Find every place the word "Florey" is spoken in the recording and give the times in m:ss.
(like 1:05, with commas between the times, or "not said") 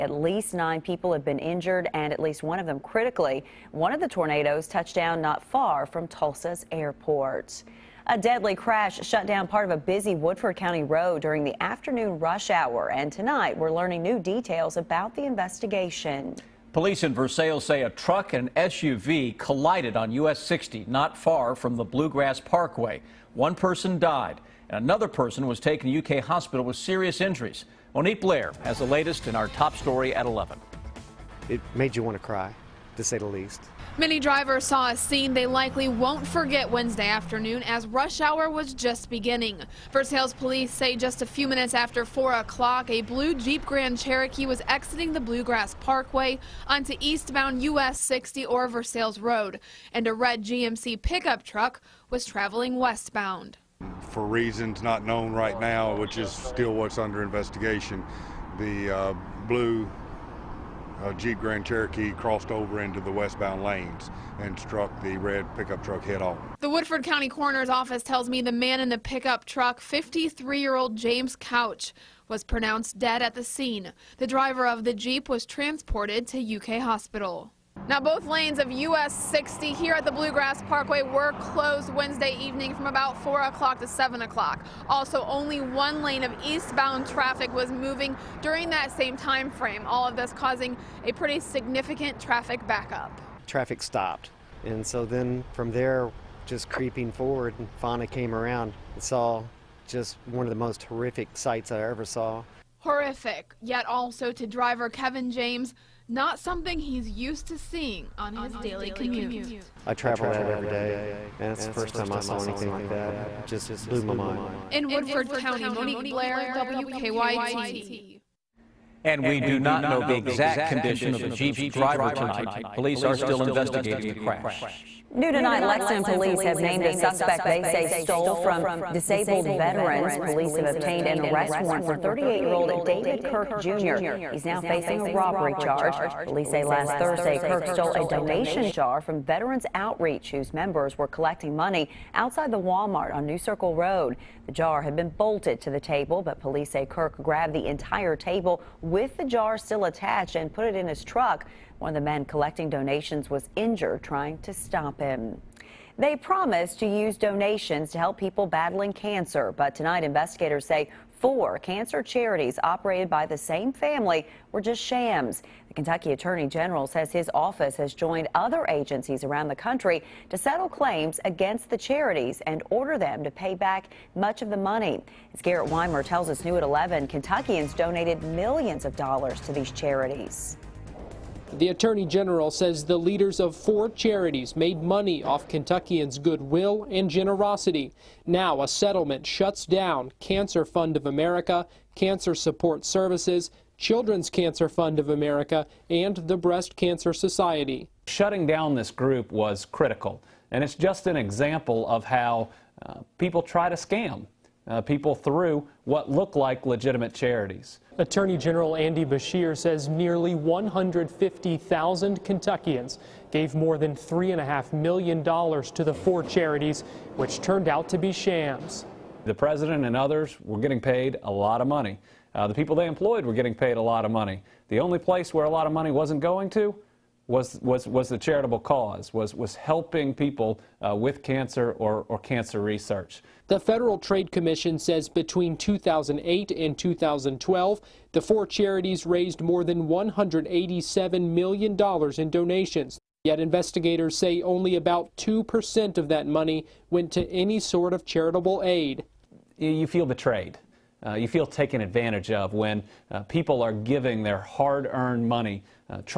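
not said.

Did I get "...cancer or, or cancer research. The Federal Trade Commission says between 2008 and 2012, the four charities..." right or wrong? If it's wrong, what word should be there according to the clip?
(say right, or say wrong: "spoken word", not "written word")
right.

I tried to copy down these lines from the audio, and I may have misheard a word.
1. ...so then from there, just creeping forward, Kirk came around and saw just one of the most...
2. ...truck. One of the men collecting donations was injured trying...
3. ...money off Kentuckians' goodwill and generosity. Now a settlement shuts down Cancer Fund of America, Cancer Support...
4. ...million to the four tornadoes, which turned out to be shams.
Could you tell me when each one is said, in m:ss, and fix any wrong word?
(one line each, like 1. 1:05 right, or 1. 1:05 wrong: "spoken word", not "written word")
1. 1:34 wrong: "Fauna", not "Kirk"
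2. 2:31 right
3. 3:04 right
4. 3:34 wrong: "charities", not "tornadoes".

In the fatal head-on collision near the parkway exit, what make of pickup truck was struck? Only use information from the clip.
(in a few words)
GMC pickup.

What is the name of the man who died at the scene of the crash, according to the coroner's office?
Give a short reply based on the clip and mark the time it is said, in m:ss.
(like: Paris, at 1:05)
James Couch, at 1:10.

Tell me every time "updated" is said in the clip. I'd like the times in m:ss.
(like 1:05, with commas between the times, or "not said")
not said.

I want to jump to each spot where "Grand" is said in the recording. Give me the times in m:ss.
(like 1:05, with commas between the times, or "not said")
0:43, 1:01.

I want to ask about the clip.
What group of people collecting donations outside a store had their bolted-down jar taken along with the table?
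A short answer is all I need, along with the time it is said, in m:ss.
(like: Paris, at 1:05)
Veterans Outreach, at 2:19.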